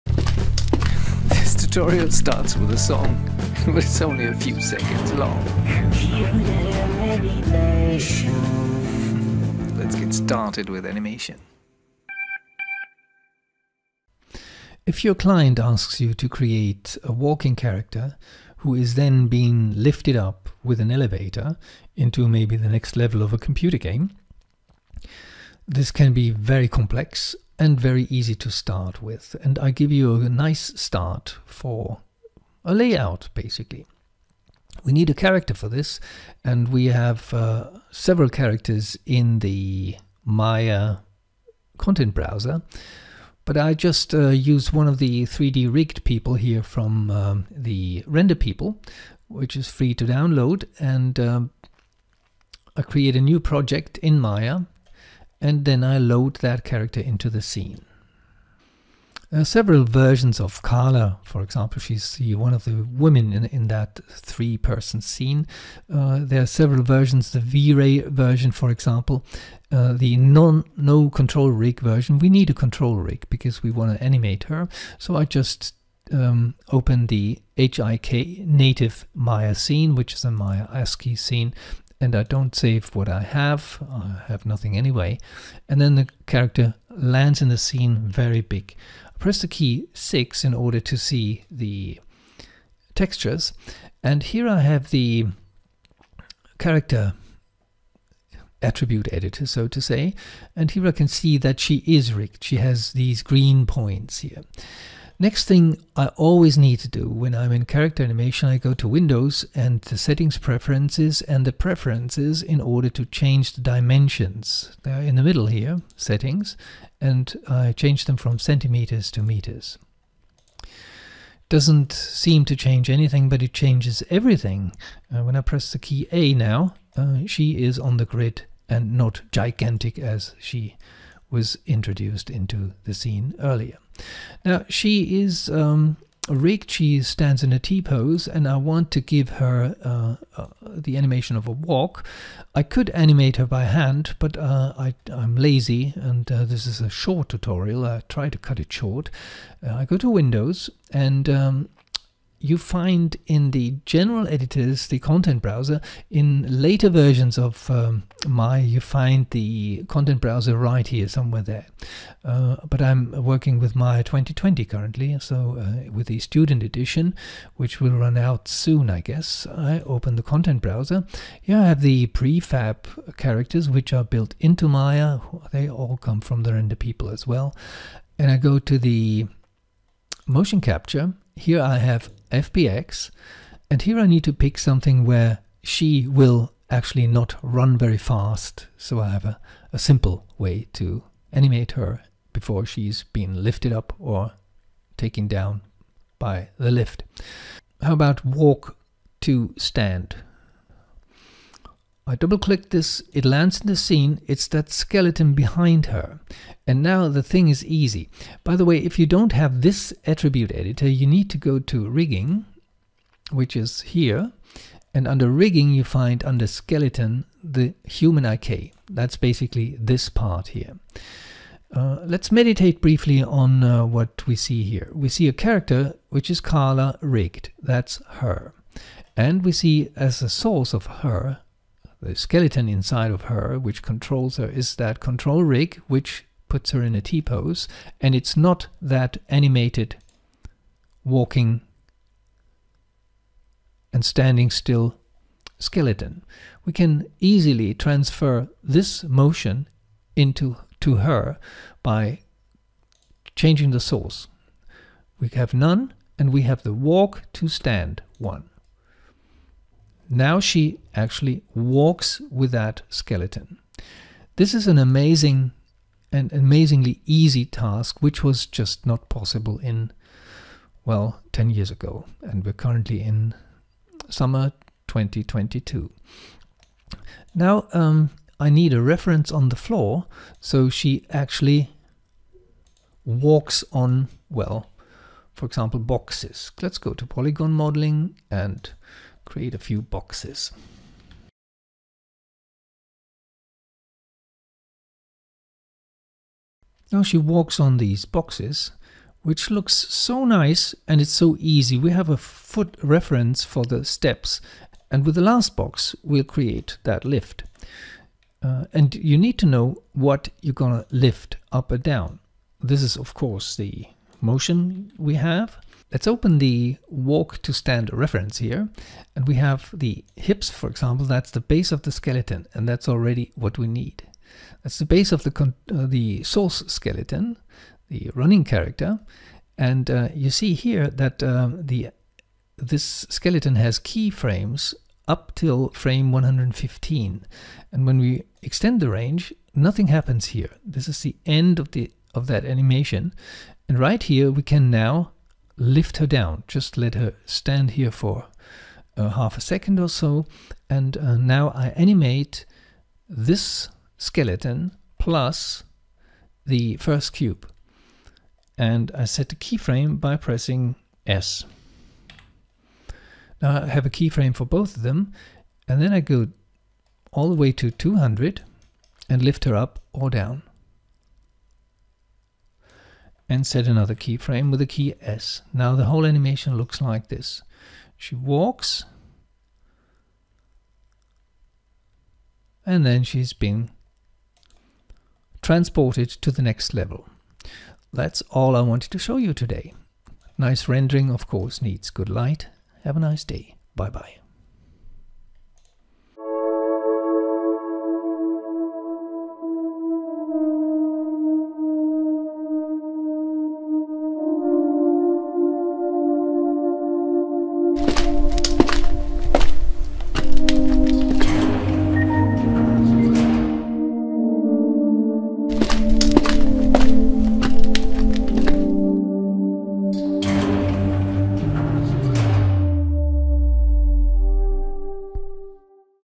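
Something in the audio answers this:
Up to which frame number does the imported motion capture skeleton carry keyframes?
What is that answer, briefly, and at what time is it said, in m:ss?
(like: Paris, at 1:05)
115, at 5:36.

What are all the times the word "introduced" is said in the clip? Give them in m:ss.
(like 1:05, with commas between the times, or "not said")
2:11.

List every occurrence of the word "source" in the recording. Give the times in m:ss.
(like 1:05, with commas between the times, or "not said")
3:50, 4:13, 5:26.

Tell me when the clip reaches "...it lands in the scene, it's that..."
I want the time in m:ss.
3:23.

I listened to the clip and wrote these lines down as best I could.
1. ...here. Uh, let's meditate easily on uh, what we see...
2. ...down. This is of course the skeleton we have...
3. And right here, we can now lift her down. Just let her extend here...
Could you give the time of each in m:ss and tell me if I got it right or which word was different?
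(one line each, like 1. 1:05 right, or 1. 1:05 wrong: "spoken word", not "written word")
1. 3:40 wrong: "briefly", not "easily"
2. 5:11 wrong: "motion", not "skeleton"
3. 5:43 wrong: "stand", not "extend".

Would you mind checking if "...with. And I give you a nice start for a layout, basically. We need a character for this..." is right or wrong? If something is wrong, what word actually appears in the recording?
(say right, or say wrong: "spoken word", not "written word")
right.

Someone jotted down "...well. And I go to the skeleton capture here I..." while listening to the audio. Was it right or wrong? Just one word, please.
wrong.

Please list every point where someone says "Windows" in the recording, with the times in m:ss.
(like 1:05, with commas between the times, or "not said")
1:48, 2:30.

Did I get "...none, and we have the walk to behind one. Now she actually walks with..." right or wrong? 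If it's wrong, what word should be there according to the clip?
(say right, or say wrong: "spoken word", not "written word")
wrong: "stand", not "behind".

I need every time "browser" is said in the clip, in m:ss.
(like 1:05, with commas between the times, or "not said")
0:42, 2:35, 2:40, 2:50.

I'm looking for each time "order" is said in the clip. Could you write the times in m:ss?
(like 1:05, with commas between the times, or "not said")
1:30, 1:52.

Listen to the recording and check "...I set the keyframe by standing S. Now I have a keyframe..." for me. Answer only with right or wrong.
wrong.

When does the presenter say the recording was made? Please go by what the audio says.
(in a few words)
summer 2022.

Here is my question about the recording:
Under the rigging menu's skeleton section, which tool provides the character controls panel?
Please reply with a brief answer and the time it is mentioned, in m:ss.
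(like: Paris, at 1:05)
Human IK, at 3:37.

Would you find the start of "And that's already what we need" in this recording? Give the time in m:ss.
5:22.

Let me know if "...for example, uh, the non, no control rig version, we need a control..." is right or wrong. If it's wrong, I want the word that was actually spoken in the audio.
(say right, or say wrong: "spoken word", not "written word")
right.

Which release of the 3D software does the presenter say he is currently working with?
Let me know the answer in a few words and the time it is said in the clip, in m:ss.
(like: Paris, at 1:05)
Maya 2020, at 2:43.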